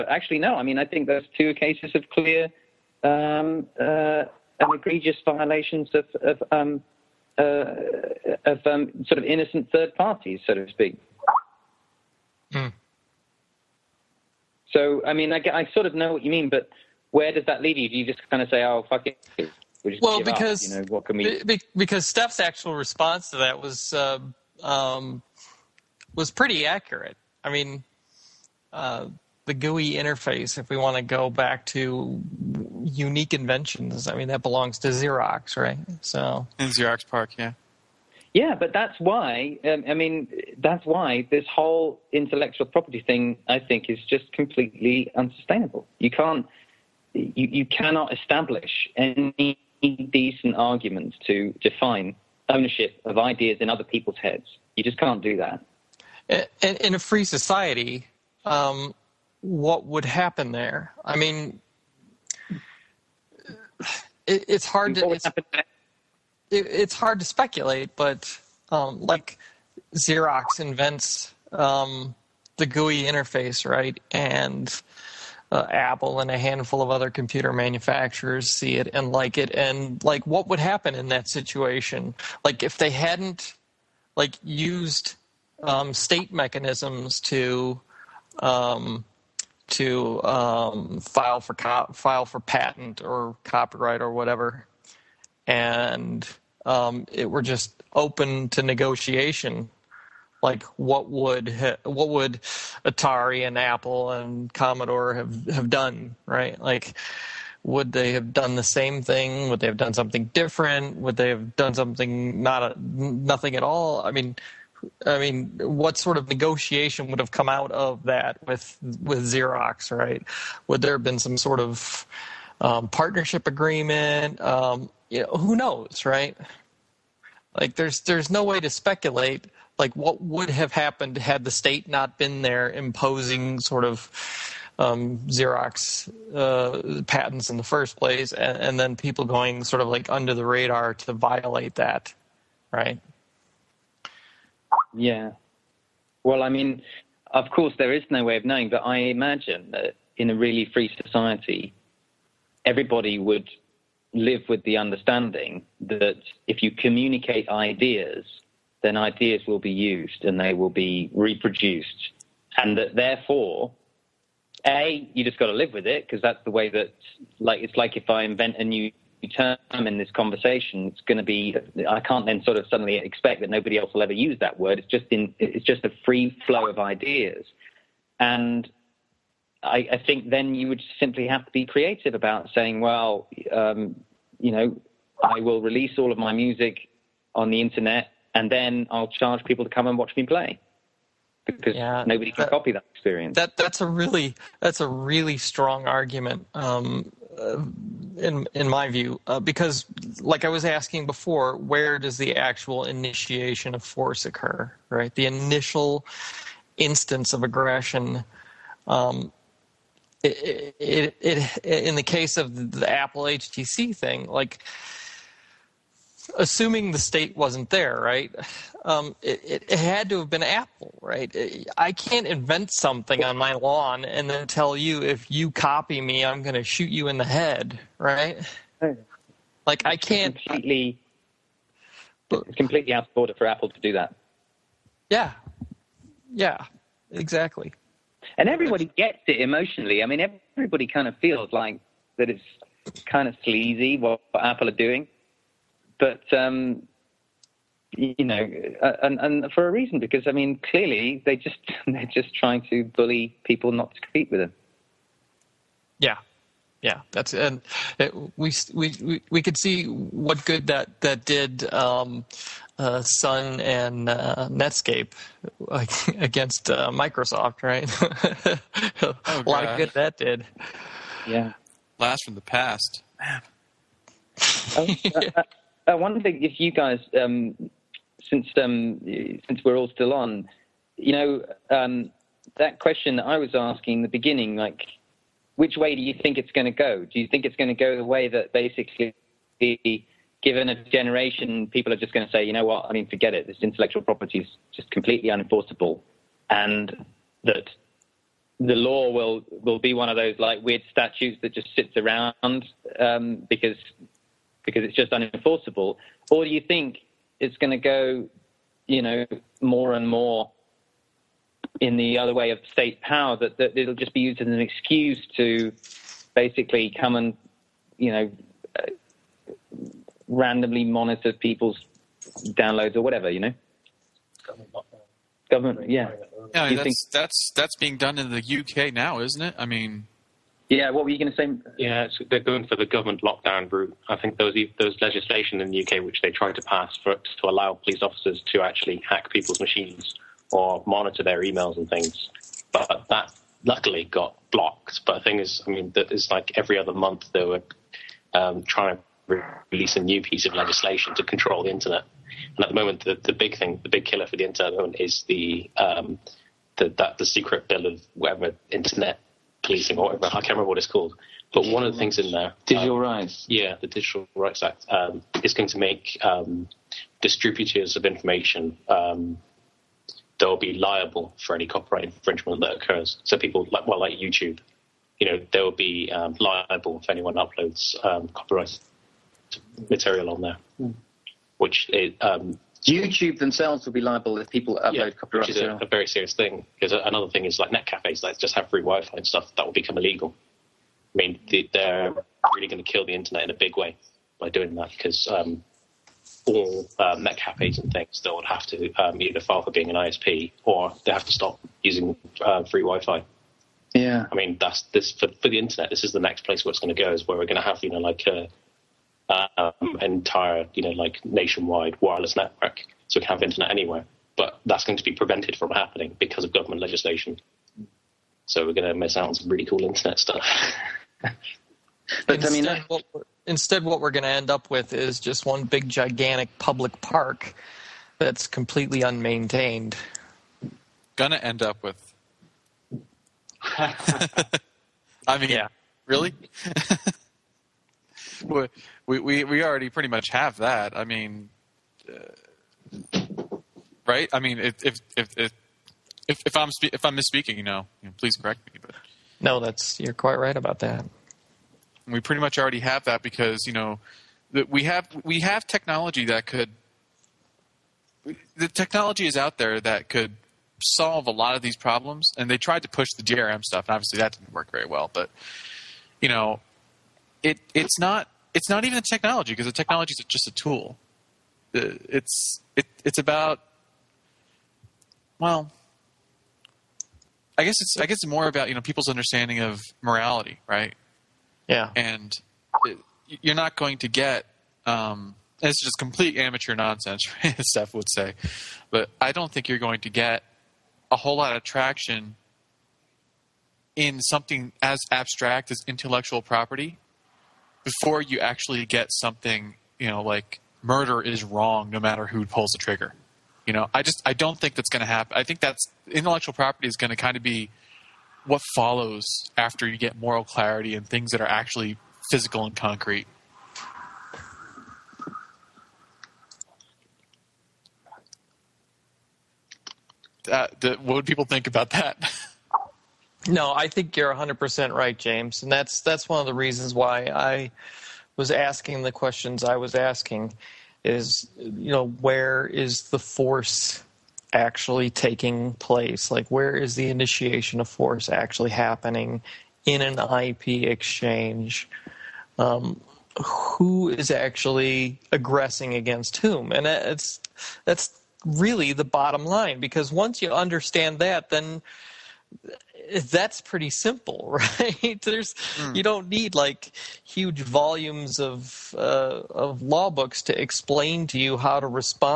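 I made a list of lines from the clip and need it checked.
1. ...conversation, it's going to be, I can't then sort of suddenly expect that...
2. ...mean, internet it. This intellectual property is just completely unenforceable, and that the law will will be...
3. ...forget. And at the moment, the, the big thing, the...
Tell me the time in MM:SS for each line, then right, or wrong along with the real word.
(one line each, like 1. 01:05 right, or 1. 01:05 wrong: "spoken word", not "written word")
1. 02:50 right
2. 04:52 wrong: "forget", not "internet"
3. 05:51 wrong: "internet", not "forget".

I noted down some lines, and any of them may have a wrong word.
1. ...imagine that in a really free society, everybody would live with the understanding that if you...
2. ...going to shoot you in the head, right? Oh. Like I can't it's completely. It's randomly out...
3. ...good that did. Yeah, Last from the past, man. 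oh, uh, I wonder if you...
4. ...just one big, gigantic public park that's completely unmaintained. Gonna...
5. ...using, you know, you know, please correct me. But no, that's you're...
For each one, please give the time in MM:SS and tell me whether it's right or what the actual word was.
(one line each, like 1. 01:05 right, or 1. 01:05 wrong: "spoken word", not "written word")
1. 02:28 right
2. 03:46 wrong: "completely", not "randomly"
3. 04:29 right
4. 07:05 right
5. 07:27 wrong: "misspeaking", not "using".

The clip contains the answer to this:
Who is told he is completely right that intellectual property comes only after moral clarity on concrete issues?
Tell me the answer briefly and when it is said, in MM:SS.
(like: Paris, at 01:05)
James, at 08:45.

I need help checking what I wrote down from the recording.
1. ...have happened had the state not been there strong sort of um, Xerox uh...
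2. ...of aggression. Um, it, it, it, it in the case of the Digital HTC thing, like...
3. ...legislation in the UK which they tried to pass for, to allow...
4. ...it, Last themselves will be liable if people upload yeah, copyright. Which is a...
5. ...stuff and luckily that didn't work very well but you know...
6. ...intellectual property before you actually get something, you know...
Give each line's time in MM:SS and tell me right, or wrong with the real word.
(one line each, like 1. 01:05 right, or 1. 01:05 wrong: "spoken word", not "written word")
1. 02:10 wrong: "imposing", not "strong"
2. 03:27 wrong: "Apple", not "Digital"
3. 05:35 right
4. 06:21 wrong: "YouTube", not "Last"
5. 07:43 wrong: "obviously", not "luckily"
6. 08:15 right.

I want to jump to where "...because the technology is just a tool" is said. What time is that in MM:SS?
07:49.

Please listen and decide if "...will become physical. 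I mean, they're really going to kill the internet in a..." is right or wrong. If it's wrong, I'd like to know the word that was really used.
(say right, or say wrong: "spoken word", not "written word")
wrong: "illegal", not "physical".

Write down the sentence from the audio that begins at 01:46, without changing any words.
Like would they have done the same thing?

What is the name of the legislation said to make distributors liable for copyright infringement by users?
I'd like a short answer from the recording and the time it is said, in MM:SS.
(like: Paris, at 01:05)
Digital Rights Act, at 06:03.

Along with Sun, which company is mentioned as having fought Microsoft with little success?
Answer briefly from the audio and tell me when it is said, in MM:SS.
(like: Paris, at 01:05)
Netscape, at 04:24.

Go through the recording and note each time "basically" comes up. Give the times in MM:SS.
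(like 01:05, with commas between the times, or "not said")
04:48, 05:16.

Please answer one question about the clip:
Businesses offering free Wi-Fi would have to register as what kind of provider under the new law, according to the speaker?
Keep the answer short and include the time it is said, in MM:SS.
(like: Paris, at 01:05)
ISP, at 06:39.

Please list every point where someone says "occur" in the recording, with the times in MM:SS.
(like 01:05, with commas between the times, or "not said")
03:24, 06:12.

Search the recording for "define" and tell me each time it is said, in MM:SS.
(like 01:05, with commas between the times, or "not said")
00:51.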